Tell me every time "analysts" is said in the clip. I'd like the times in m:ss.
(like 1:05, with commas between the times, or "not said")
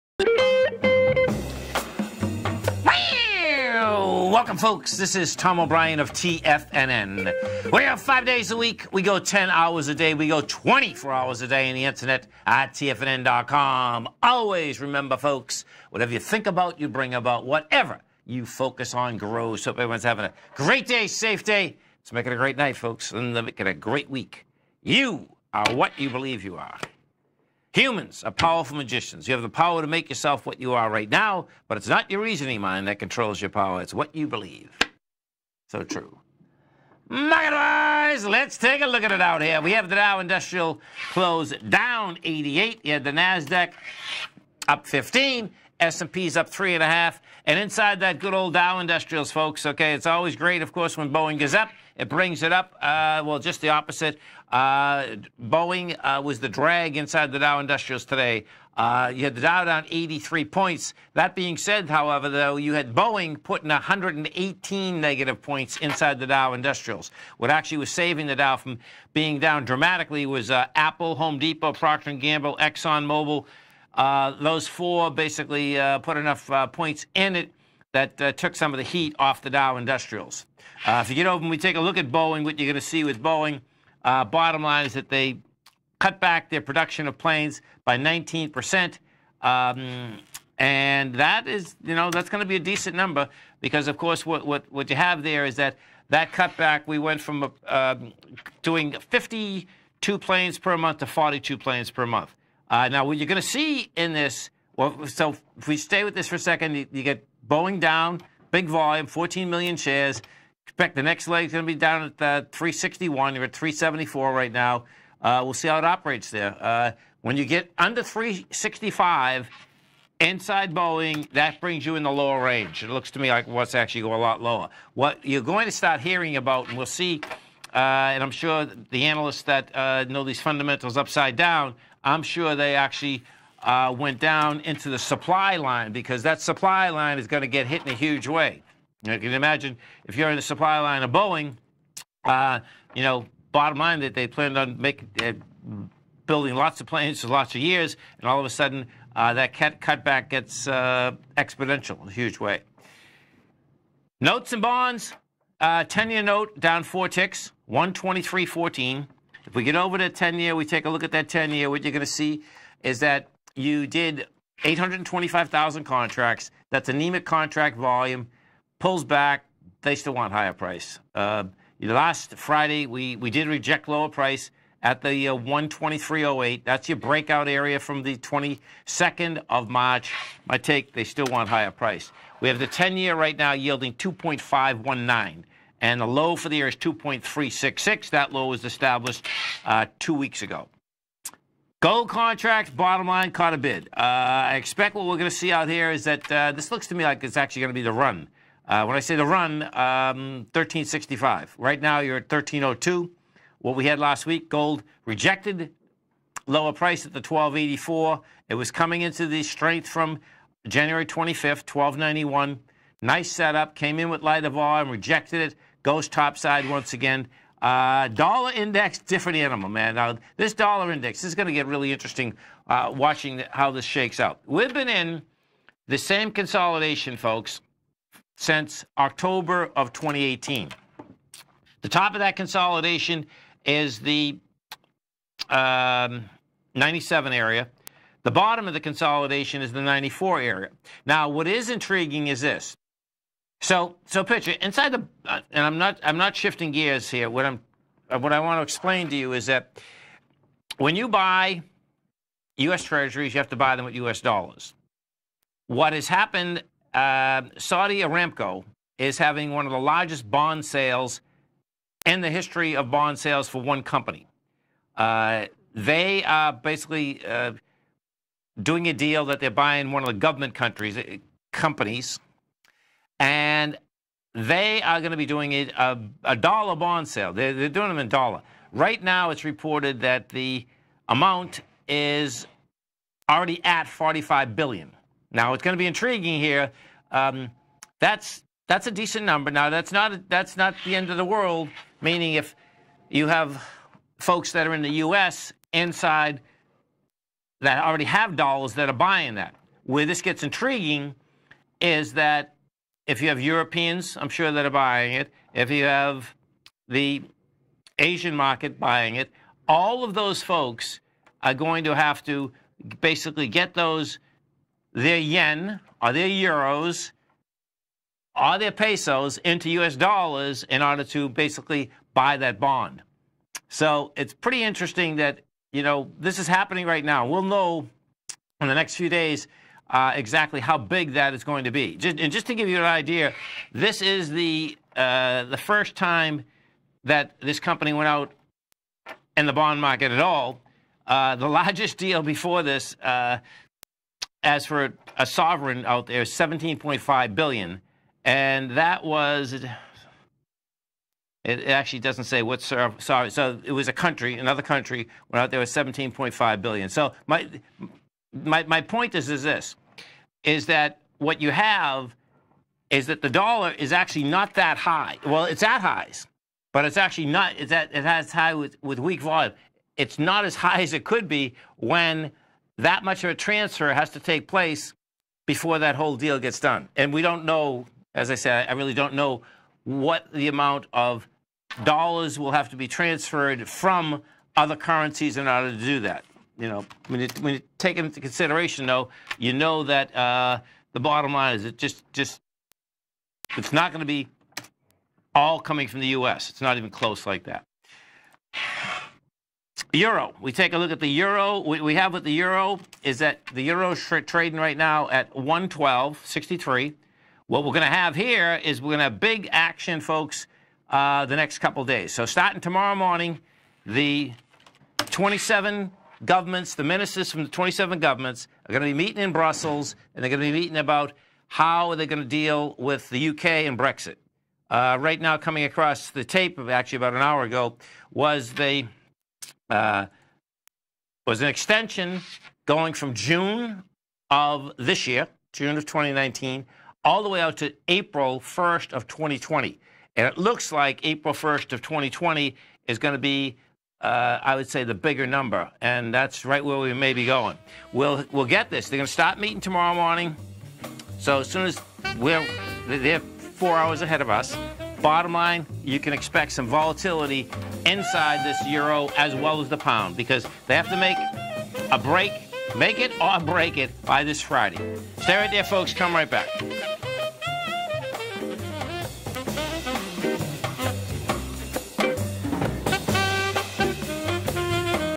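2:09.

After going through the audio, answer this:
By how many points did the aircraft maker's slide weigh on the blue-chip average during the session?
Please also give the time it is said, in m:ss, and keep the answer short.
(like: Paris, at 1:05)
118, at 1:03.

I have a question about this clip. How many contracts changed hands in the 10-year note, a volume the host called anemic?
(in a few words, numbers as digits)
825,000.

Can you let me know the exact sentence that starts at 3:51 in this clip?
The top of that consolidation is the um, 97 area.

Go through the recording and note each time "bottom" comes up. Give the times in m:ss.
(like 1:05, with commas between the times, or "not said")
1:24, 2:23, 3:12, 3:58, 6:30, 7:35.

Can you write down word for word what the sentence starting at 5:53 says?
So it was a country, another country went out there with 17.5 billion.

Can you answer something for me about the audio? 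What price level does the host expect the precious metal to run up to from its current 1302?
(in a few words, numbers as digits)
1365.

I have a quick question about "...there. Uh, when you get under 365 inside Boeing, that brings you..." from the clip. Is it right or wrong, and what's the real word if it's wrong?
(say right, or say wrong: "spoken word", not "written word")
right.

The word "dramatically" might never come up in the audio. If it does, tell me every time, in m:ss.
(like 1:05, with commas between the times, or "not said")
1:09.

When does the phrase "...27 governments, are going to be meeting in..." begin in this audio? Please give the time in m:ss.
6:57.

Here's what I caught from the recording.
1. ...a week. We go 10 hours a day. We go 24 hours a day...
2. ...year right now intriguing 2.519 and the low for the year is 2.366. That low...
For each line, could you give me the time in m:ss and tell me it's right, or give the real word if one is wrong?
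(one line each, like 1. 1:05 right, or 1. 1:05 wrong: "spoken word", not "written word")
1. 0:08 right
2. 3:02 wrong: "yielding", not "intriguing".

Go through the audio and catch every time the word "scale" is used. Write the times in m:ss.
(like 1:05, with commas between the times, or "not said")
not said.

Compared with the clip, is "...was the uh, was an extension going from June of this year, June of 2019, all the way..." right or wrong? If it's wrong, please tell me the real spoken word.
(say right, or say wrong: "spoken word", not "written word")
right.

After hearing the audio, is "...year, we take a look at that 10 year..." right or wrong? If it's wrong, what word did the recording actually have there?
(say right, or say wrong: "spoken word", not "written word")
right.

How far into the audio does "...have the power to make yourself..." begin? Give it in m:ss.
0:29.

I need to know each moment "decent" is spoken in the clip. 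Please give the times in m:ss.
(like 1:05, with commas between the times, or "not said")
1:32, 4:48.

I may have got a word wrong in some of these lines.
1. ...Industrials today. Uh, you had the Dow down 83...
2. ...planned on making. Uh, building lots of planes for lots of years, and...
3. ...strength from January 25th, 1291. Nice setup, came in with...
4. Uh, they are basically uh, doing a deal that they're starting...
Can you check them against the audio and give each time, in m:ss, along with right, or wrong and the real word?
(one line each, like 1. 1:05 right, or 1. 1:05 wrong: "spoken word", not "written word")
1. 0:57 right
2. 2:24 right
3. 3:29 right
4. 4:24 wrong: "buying", not "starting".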